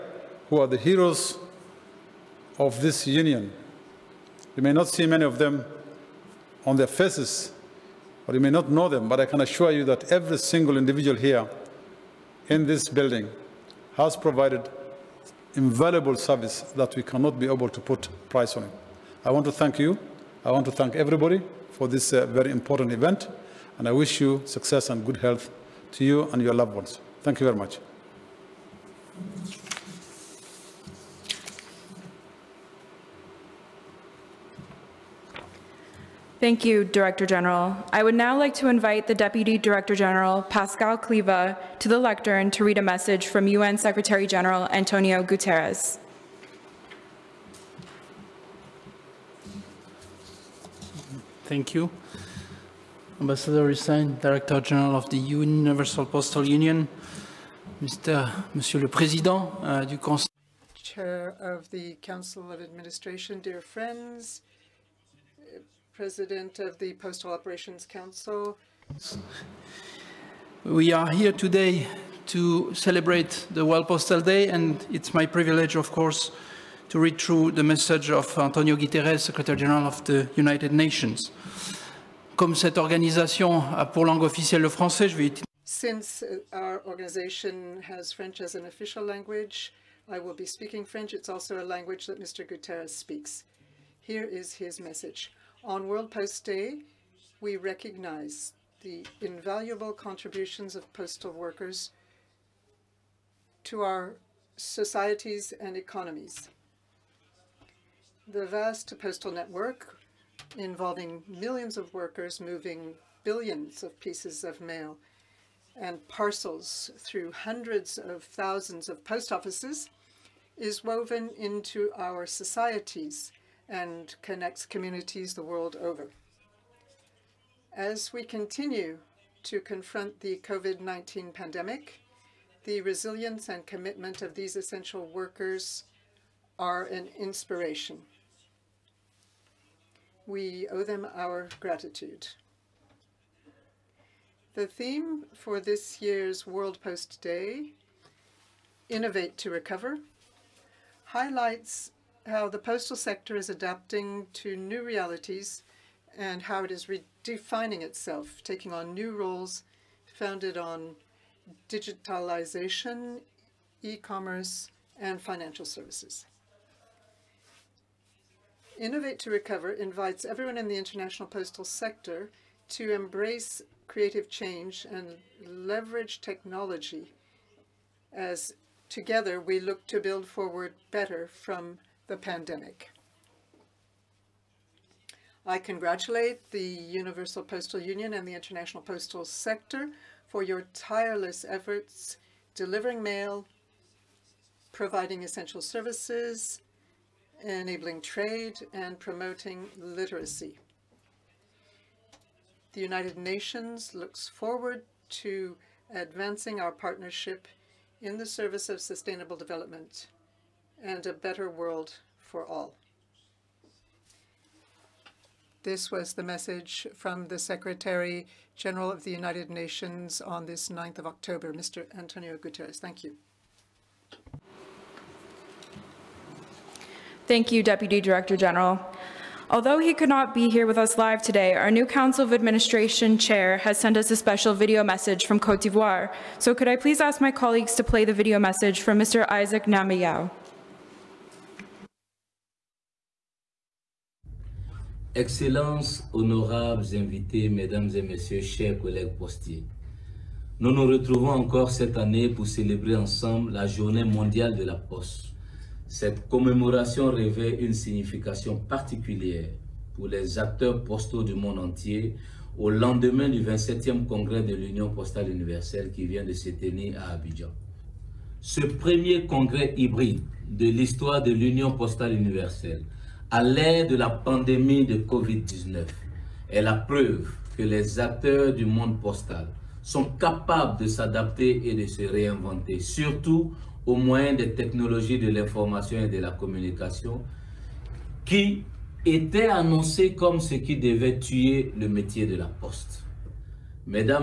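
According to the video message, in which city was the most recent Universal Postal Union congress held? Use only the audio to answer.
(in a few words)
Abidjan.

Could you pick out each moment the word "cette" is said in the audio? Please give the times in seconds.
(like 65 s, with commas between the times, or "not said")
82 s, 251 s, 255 s.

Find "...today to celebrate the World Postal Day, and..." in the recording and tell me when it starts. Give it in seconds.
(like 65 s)
71 s.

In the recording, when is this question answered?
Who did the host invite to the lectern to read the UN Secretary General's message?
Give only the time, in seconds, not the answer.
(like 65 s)
40 s.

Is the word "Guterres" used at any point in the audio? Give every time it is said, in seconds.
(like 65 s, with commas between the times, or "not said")
45 s, 78 s, 92 s, 222 s.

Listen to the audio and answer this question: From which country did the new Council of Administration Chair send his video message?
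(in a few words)
Cote d'Ivoire.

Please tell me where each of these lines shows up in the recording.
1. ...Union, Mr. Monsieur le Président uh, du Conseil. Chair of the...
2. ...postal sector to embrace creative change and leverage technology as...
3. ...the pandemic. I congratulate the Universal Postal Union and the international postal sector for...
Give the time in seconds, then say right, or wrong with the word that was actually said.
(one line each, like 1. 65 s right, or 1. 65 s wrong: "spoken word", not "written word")
1. 56 s right
2. 171 s right
3. 182 s right.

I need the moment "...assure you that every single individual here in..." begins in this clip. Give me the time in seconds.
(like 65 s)
9 s.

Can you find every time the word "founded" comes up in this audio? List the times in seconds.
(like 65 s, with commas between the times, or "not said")
160 s.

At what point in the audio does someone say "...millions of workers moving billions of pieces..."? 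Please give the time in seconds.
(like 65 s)
111 s.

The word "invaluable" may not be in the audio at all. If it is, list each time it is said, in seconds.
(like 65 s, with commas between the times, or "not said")
15 s, 99 s.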